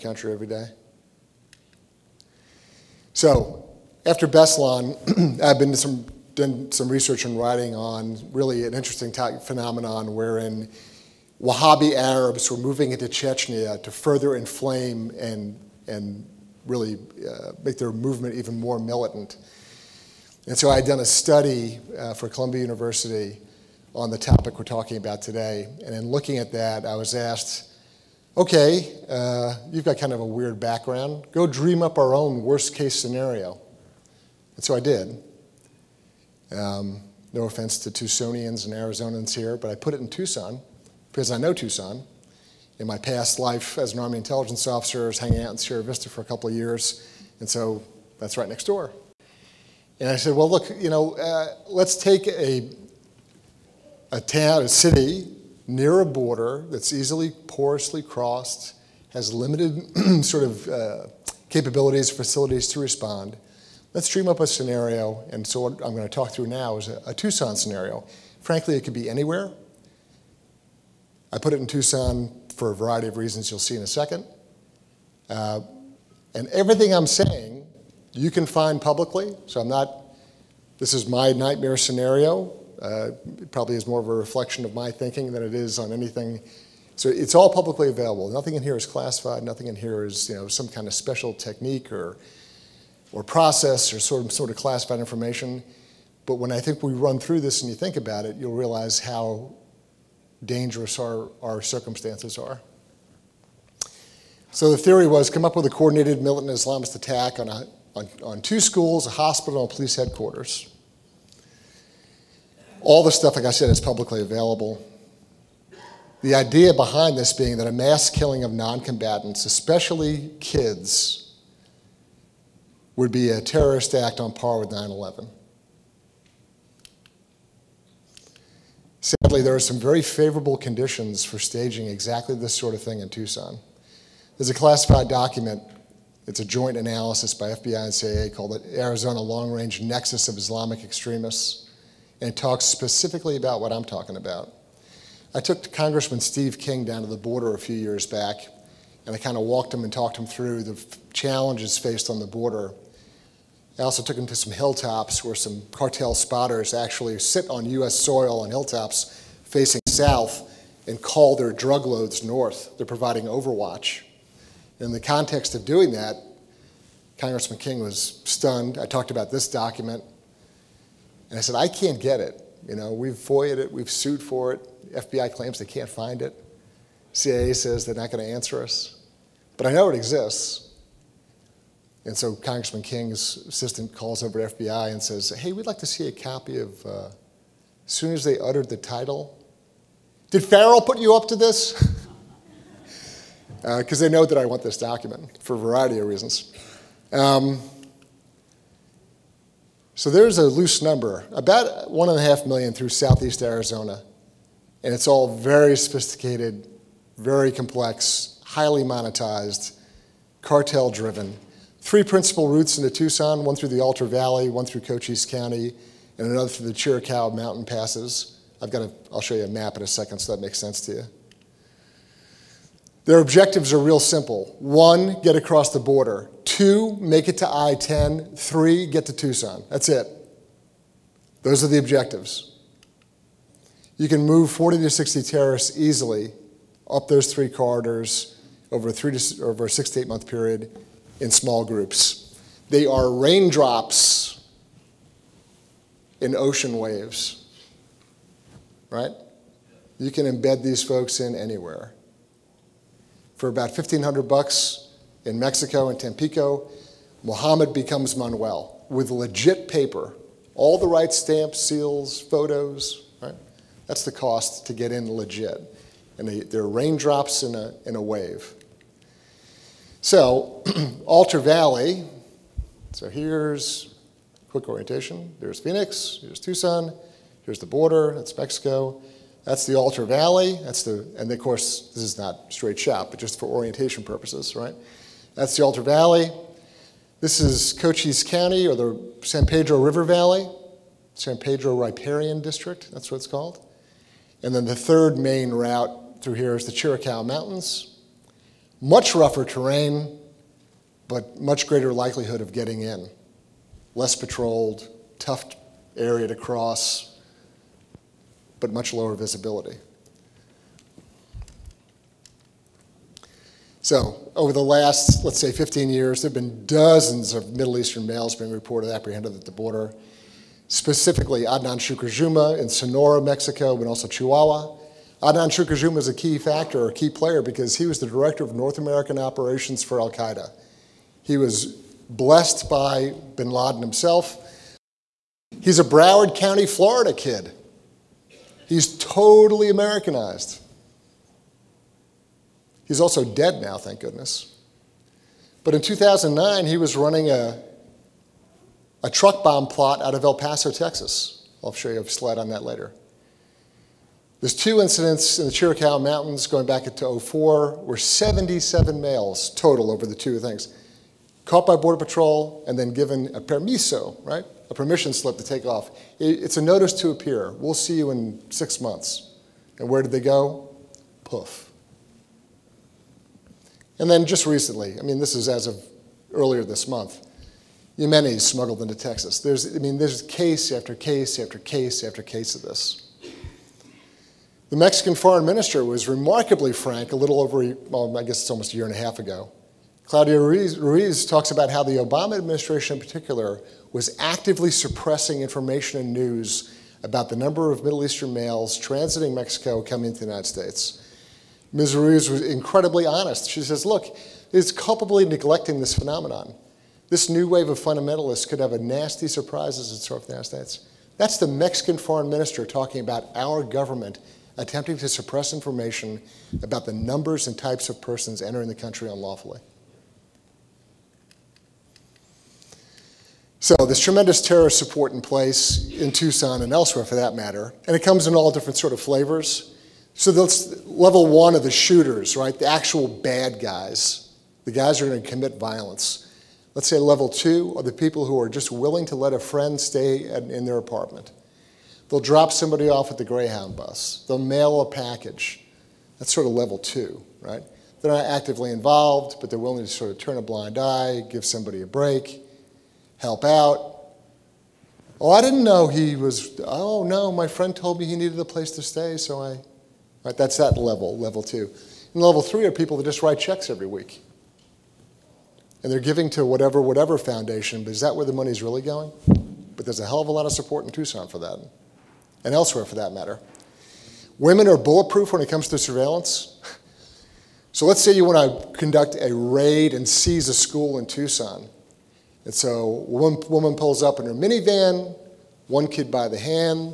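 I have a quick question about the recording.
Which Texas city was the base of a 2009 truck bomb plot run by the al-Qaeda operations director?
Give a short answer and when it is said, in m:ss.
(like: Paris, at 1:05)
El Paso, at 5:50.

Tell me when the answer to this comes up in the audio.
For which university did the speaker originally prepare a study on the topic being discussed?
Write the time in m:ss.
0:22.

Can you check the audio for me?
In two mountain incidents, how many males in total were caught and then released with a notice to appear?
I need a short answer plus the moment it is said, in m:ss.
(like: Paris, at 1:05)
77, at 5:57.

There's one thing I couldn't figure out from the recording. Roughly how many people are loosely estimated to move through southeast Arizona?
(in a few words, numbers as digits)
1.5 million.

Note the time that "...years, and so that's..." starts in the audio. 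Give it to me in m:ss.
0:46.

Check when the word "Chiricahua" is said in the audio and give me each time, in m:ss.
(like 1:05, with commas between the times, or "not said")
3:36, 4:56, 5:55.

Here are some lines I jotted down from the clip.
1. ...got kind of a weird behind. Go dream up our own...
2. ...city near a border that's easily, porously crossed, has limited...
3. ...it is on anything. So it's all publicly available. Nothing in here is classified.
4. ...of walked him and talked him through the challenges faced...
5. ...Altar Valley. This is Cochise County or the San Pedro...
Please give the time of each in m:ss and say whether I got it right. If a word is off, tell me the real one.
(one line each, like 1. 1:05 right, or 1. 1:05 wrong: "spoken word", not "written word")
1. 0:29 wrong: "background", not "behind"
2. 0:54 right
3. 1:25 right
4. 2:29 right
5. 4:45 right.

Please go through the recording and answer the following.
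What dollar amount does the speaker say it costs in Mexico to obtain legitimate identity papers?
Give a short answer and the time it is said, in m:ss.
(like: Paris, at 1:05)
$1,500, at 4:13.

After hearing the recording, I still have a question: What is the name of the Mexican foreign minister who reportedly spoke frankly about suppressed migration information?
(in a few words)
Claudia Ruiz.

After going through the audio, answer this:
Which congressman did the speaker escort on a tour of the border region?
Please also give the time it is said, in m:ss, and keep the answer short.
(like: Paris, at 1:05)
Steve King, at 2:26.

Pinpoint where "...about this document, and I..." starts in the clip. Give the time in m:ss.
2:49.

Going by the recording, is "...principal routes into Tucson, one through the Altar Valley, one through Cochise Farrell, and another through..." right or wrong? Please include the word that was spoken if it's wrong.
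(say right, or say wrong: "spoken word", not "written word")
wrong: "County", not "Farrell".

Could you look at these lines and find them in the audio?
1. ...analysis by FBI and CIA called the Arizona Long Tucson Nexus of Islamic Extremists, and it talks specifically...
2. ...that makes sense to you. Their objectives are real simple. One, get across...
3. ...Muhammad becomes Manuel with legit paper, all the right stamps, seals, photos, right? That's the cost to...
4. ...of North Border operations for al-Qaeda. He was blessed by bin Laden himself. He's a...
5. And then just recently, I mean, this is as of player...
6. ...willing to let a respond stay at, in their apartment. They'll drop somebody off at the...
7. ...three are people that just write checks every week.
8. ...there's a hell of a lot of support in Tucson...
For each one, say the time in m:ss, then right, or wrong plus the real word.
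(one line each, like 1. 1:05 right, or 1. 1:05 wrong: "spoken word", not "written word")
1. 2:16 wrong: "Range", not "Tucson"
2. 3:40 right
3. 4:17 right
4. 5:28 wrong: "American", not "Border"
5. 6:13 wrong: "earlier", not "player"
6. 7:18 wrong: "friend", not "respond"
7. 7:42 right
8. 7:49 right.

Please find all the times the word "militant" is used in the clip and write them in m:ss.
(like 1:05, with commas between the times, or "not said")
0:18, 1:46.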